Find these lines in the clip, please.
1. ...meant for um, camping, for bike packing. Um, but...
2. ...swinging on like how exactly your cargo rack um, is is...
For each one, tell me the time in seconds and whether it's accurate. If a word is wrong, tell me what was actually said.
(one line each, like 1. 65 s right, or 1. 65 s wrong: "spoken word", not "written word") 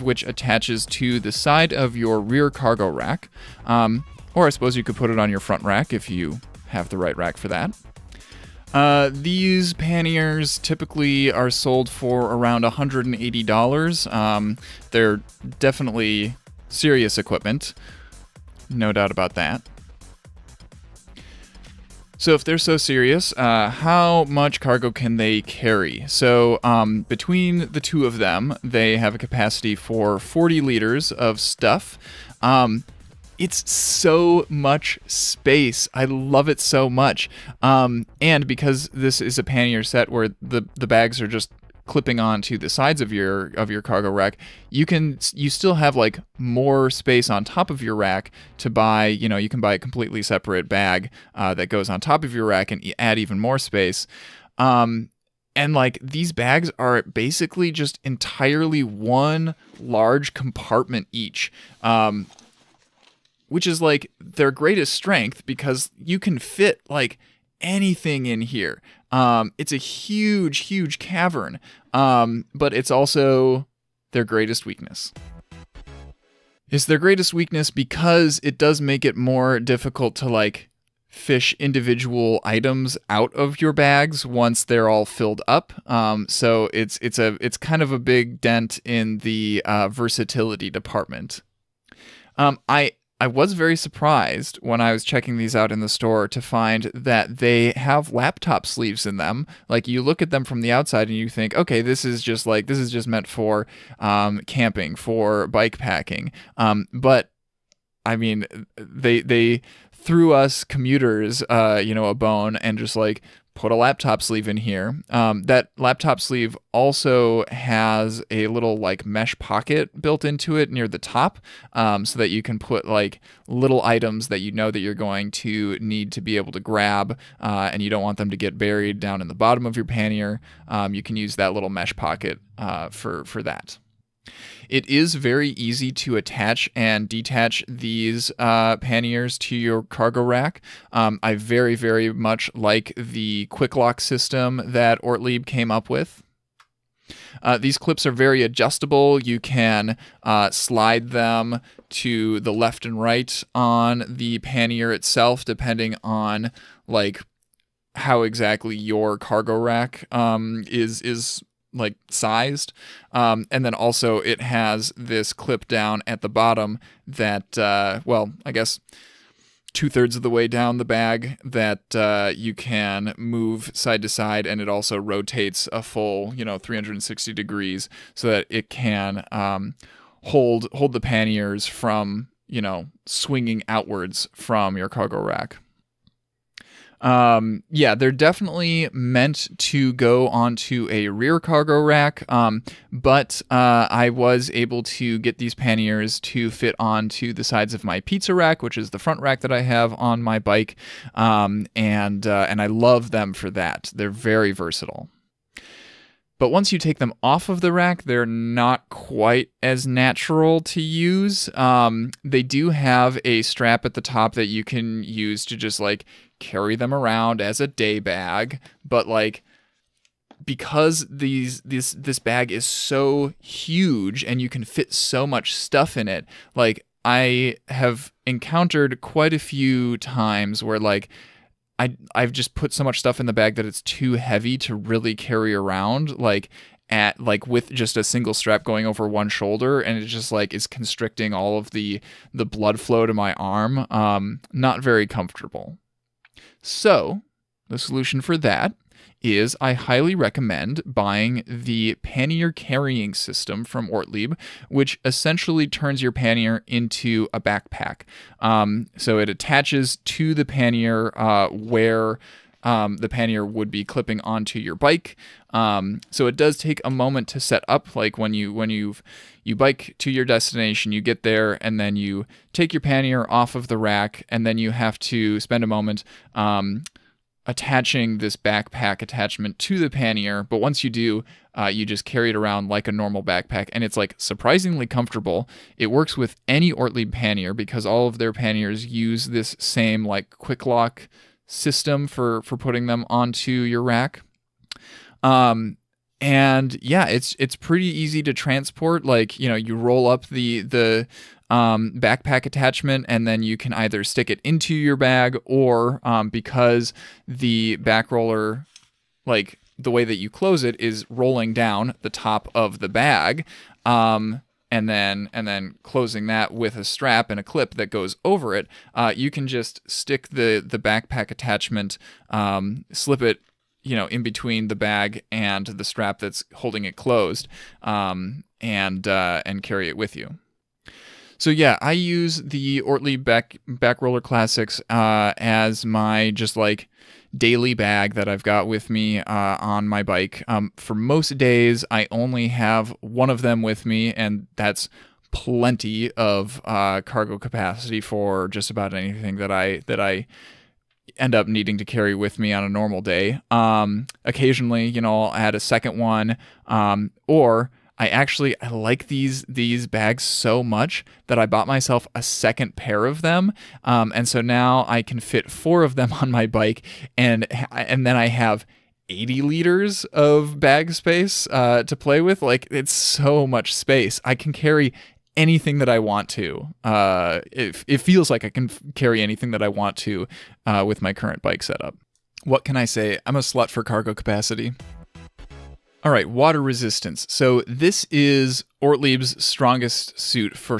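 1. 103 s right
2. 155 s wrong: "depending", not "swinging".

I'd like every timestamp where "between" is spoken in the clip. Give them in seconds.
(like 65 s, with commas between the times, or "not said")
27 s, 324 s.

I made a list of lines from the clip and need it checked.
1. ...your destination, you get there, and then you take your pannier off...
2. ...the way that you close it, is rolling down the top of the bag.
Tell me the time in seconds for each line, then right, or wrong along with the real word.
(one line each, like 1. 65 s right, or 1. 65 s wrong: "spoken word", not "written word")
1. 270 s right
2. 309 s right.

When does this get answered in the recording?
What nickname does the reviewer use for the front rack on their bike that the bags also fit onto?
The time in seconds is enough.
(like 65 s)
198 s.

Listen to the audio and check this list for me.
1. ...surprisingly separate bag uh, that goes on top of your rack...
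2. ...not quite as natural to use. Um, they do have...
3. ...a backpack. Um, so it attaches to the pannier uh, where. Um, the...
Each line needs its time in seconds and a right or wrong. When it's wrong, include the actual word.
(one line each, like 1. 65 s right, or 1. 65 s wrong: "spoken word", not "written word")
1. 49 s wrong: "completely", not "surprisingly"
2. 208 s right
3. 257 s right.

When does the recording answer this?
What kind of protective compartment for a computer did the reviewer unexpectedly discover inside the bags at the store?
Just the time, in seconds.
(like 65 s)
98 s.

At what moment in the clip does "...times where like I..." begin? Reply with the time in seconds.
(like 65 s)
229 s.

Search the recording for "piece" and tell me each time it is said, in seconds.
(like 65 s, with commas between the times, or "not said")
not said.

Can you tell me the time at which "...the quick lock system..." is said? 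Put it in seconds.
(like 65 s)
142 s.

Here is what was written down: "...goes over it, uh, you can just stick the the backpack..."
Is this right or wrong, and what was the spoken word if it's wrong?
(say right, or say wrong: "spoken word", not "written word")
right.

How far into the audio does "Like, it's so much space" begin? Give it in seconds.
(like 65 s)
372 s.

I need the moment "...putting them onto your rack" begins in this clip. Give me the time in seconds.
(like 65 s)
292 s.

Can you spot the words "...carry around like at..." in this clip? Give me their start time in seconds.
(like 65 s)
235 s.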